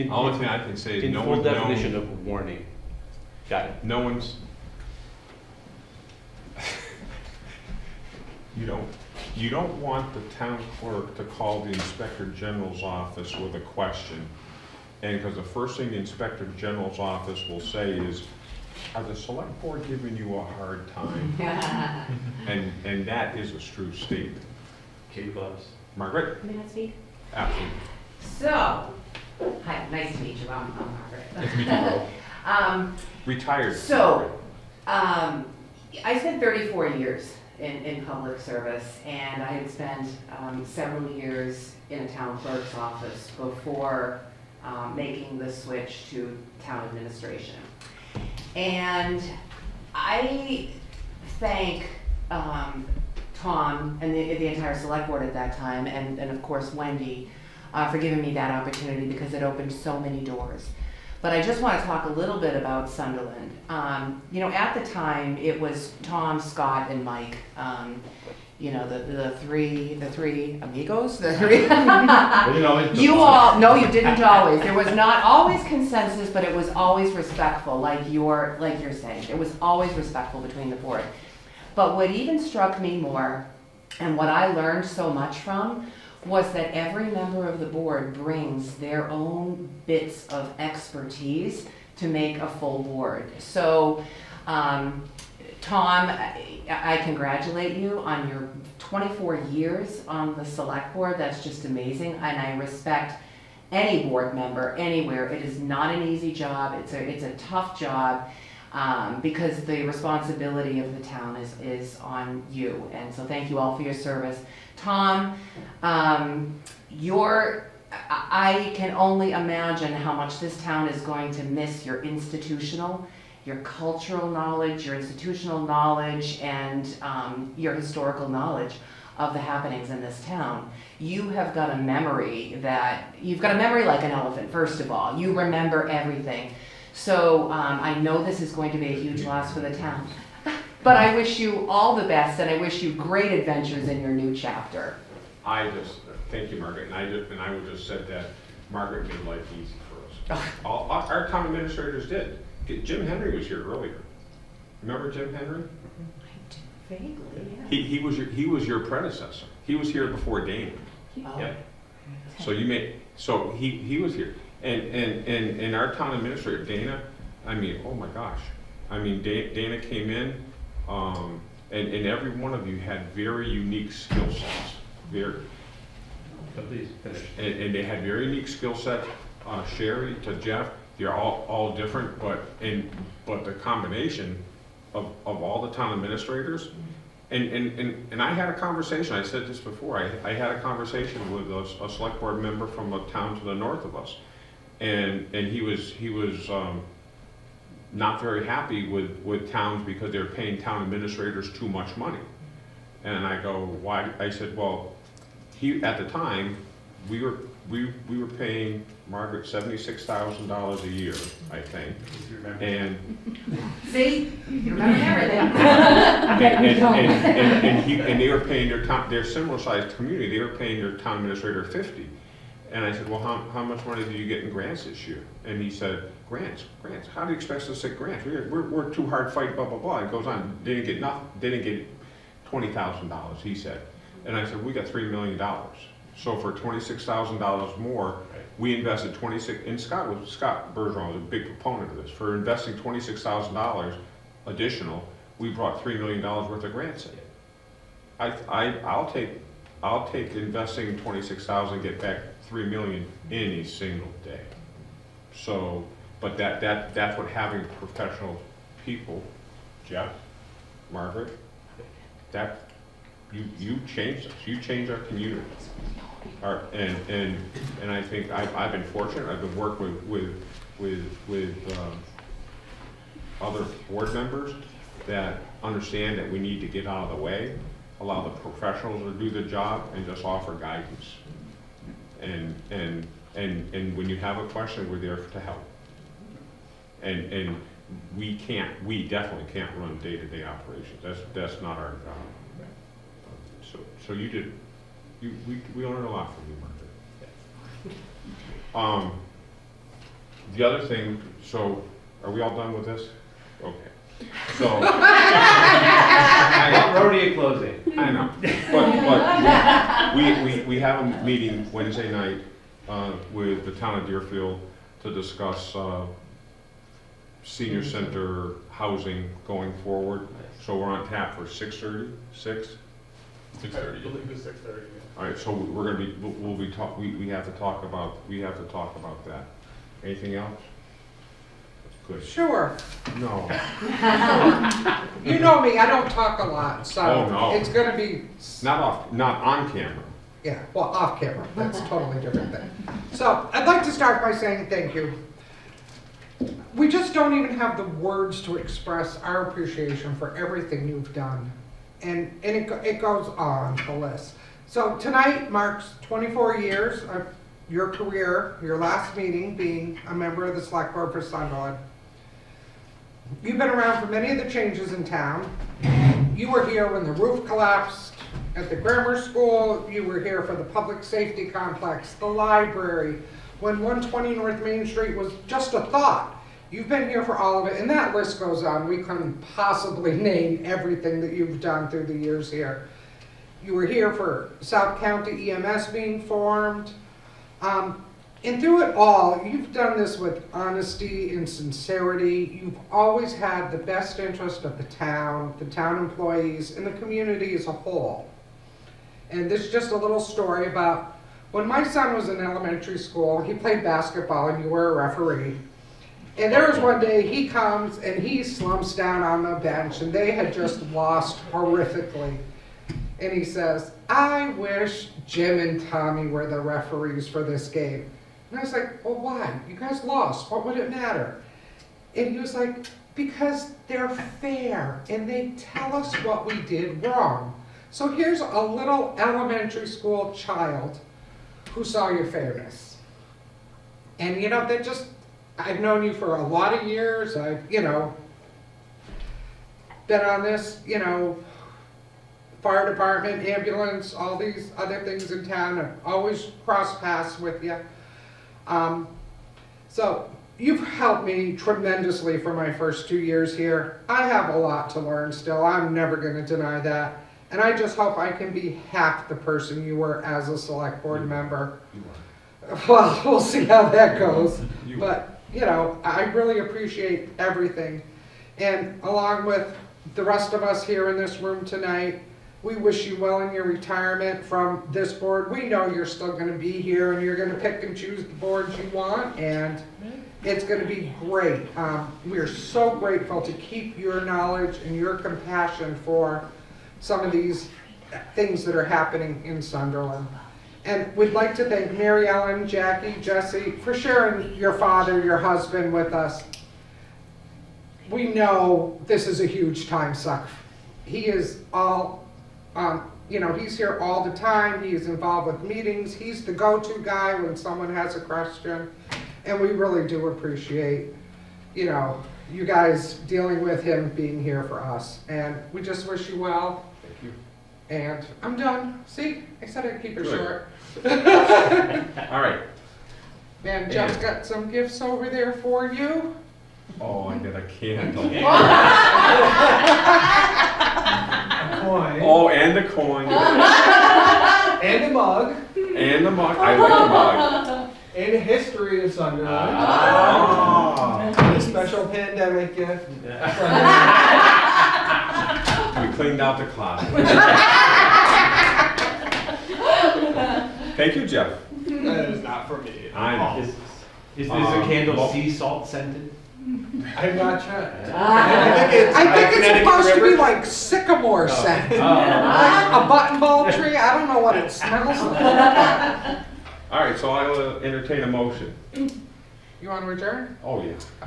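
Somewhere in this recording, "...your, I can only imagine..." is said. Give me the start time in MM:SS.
01:56.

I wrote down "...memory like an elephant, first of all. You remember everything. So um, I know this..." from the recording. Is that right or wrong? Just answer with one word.
right.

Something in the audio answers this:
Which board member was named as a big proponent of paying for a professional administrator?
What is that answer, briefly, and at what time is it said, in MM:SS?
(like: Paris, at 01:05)
Scott Bergeron, at 04:00.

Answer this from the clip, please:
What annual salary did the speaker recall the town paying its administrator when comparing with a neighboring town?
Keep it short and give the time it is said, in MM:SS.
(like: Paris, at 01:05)
$76,000, at 03:29.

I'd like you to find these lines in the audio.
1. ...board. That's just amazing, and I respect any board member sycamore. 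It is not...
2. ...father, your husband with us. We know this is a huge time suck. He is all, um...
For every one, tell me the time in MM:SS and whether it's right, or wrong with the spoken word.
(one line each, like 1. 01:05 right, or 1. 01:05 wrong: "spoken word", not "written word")
1. 01:40 wrong: "anywhere", not "sycamore"
2. 08:14 right.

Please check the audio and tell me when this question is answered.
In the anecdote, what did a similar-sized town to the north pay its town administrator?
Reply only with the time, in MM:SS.
03:41.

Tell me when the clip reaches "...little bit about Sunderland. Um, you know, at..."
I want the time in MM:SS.
01:02.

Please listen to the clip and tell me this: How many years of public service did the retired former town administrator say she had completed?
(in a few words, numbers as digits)
34.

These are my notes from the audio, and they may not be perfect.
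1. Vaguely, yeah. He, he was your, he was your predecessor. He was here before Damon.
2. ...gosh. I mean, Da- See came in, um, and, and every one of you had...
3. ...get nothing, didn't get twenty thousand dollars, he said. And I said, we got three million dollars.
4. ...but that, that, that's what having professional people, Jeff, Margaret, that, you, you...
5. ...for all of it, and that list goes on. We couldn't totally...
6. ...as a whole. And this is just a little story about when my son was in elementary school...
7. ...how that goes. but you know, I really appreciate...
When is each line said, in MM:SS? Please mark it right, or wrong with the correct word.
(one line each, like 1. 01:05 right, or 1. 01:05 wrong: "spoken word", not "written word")
1. 02:36 right
2. 02:48 wrong: "Dana", not "See"
3. 03:50 right
4. 04:16 right
5. 06:17 wrong: "possibly", not "totally"
6. 06:37 right
7. 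07:43 right.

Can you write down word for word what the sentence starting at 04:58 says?
Um, the other thing, so are we all done with this?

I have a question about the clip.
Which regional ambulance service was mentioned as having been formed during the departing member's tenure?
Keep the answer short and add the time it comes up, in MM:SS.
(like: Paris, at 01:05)
South County EMS, at 06:24.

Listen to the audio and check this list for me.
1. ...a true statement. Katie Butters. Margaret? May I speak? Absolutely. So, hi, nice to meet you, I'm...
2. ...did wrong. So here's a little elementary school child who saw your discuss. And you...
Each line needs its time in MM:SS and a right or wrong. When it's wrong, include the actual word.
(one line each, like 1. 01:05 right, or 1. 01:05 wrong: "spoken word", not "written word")
1. 00:23 right
2. 07:06 wrong: "fairness", not "discuss".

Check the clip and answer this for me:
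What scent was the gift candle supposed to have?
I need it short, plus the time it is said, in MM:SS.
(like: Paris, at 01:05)
Sycamore, at 09:20.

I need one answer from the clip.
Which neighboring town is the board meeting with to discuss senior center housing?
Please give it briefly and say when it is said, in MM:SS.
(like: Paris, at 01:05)
Deerfield, at 05:14.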